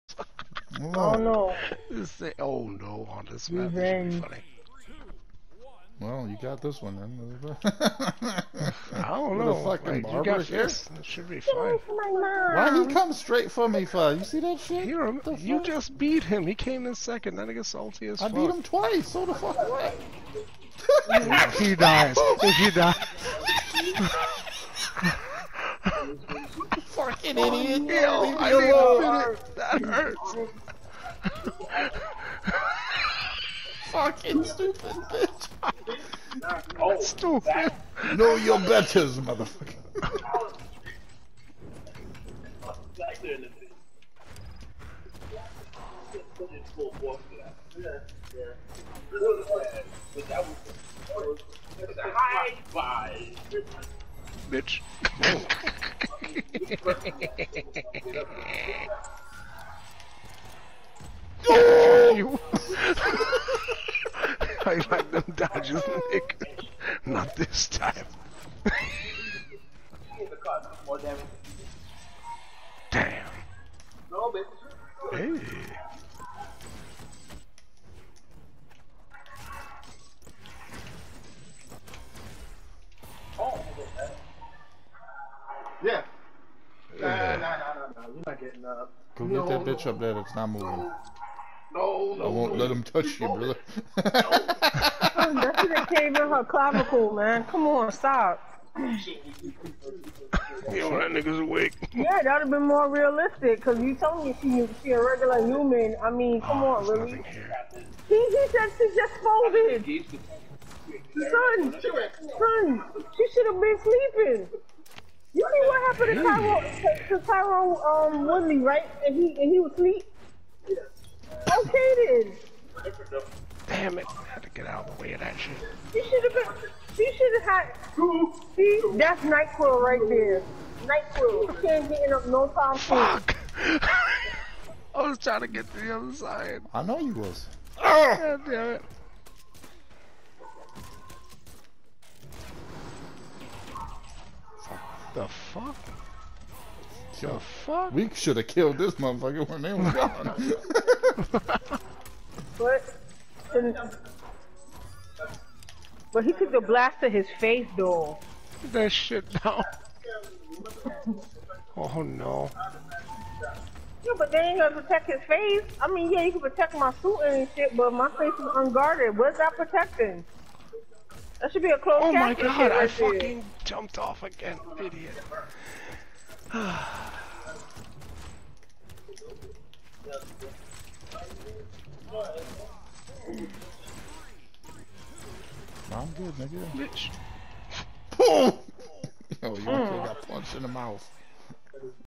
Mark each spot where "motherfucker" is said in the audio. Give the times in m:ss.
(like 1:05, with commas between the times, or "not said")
0:39, 2:28.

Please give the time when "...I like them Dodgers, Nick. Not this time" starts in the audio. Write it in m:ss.
1:04.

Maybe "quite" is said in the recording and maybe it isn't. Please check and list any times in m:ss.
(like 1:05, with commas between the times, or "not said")
not said.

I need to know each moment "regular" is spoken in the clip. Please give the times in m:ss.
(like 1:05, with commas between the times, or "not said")
1:45.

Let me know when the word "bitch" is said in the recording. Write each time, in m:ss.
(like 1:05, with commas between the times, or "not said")
0:35, 0:54, 1:29, 3:06.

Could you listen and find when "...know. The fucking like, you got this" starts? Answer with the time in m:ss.
0:09.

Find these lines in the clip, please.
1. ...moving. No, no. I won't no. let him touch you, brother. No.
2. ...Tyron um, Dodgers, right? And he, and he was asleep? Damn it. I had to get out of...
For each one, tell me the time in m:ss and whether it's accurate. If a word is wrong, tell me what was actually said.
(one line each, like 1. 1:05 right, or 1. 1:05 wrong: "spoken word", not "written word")
1. 1:30 right
2. 1:57 wrong: "Woodley", not "Dodgers".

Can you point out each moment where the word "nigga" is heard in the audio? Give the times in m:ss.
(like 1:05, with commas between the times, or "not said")
1:41, 3:06.